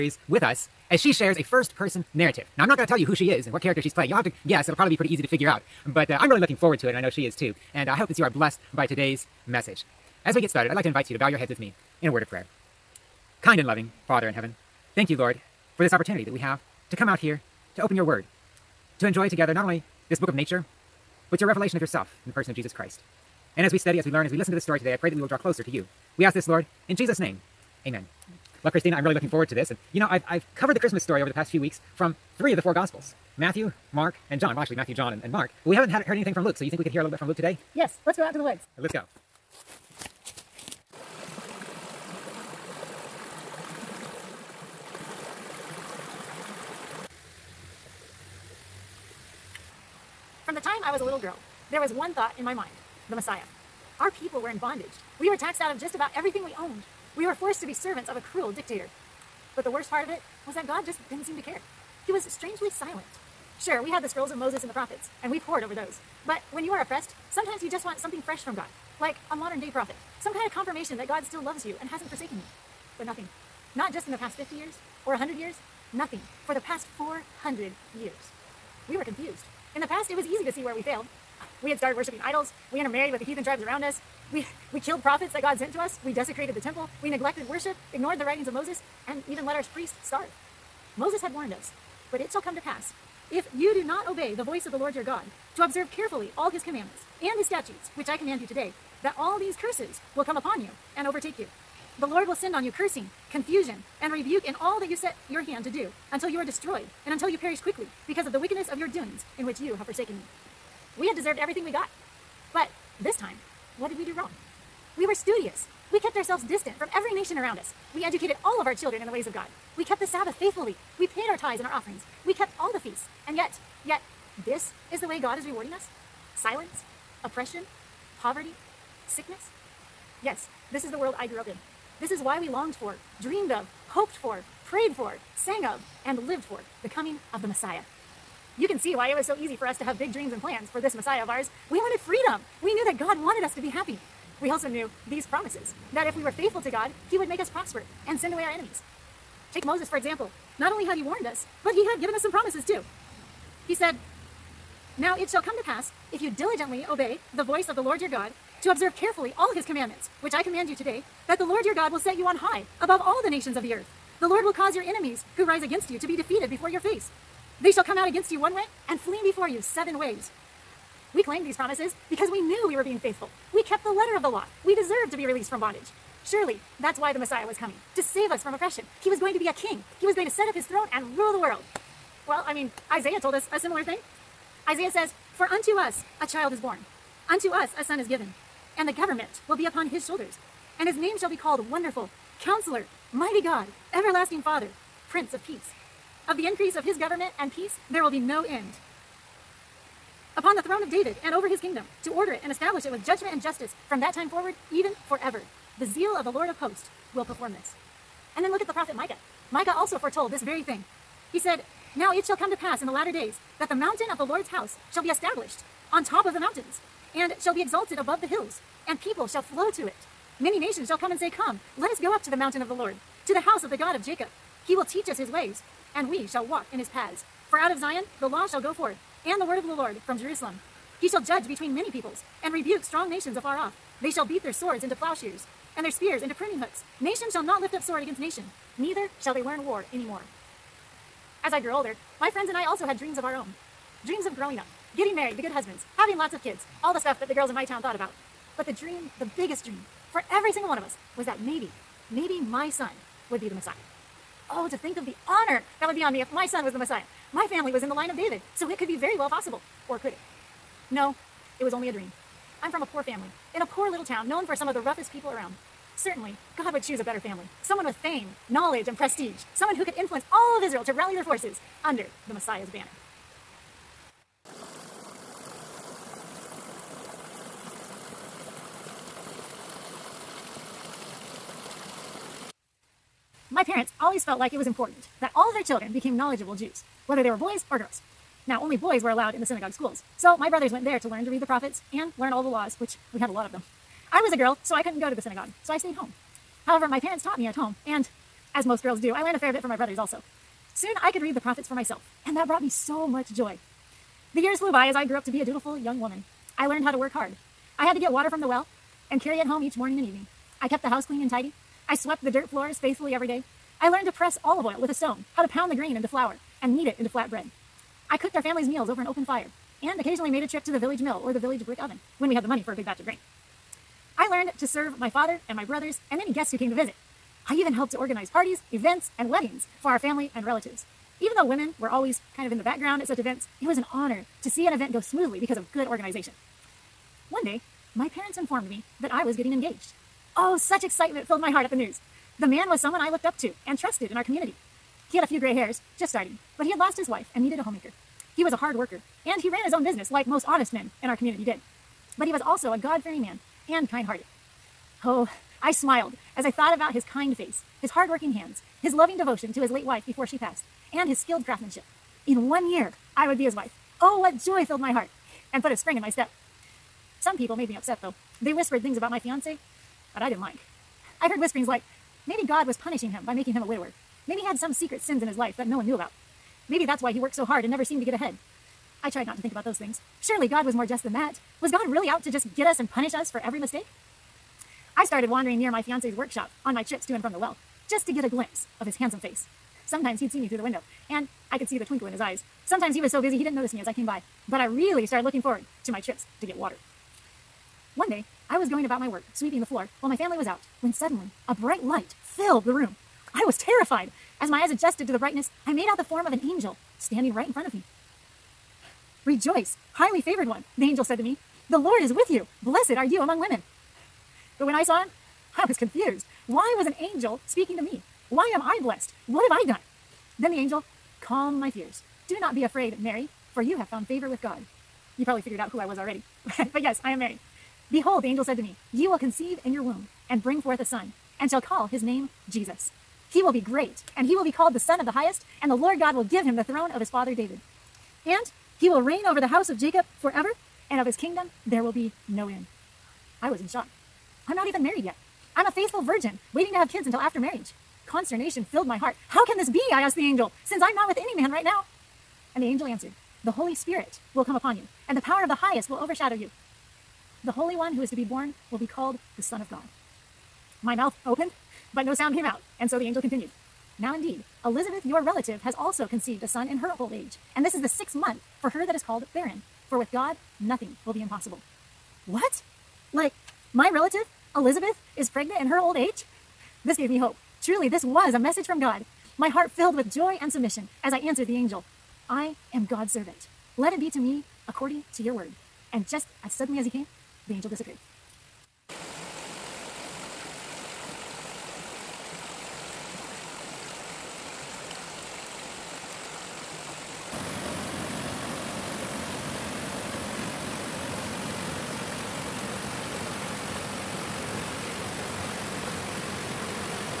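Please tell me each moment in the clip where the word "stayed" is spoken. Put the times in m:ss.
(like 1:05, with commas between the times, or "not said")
4:55.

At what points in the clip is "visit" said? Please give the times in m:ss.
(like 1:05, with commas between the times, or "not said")
5:26.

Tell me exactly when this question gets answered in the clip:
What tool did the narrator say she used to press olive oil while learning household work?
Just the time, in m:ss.
5:14.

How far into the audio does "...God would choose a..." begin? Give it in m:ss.
4:26.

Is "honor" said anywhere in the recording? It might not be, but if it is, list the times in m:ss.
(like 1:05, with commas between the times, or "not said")
4:15, 5:33.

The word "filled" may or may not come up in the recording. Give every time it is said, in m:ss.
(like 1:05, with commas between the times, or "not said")
5:41, 6:04, 6:42, 7:28, 7:59.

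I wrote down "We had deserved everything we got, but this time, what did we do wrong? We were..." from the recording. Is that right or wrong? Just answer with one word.
right.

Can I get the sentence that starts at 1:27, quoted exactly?
We neglected worship, ignored the writings of Moses, and even let our priests starve.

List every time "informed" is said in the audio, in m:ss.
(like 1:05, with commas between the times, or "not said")
5:38.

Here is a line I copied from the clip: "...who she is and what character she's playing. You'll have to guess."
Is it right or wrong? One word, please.
right.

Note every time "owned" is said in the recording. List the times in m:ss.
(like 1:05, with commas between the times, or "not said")
0:56.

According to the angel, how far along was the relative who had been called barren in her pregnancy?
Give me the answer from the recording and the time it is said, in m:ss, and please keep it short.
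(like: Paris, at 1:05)
sixth month, at 7:47.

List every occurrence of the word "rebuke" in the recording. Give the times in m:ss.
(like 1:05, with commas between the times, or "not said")
1:44, 3:52.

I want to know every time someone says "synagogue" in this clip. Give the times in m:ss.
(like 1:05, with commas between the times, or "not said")
4:49, 4:55.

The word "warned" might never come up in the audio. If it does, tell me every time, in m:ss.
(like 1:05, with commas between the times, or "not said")
1:31, 2:31.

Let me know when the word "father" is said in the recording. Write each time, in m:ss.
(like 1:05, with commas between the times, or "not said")
0:14, 3:14, 5:25, 7:17.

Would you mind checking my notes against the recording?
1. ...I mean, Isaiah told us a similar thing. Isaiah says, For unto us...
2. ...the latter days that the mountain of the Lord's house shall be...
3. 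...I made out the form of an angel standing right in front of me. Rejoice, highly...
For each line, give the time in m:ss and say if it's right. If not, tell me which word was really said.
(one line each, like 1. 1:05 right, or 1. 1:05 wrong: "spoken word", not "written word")
1. 3:02 right
2. 3:32 right
3. 6:45 right.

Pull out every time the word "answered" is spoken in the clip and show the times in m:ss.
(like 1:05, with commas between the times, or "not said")
7:32, 8:01.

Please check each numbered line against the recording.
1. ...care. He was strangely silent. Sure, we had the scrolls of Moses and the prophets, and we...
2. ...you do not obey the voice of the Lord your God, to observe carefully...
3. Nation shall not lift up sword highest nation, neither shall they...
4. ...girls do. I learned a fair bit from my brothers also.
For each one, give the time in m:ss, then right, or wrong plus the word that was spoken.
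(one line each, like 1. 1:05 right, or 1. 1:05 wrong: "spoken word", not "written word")
1. 1:01 right
2. 1:33 right
3. 3:57 wrong: "against", not "highest"
4. 4:58 right.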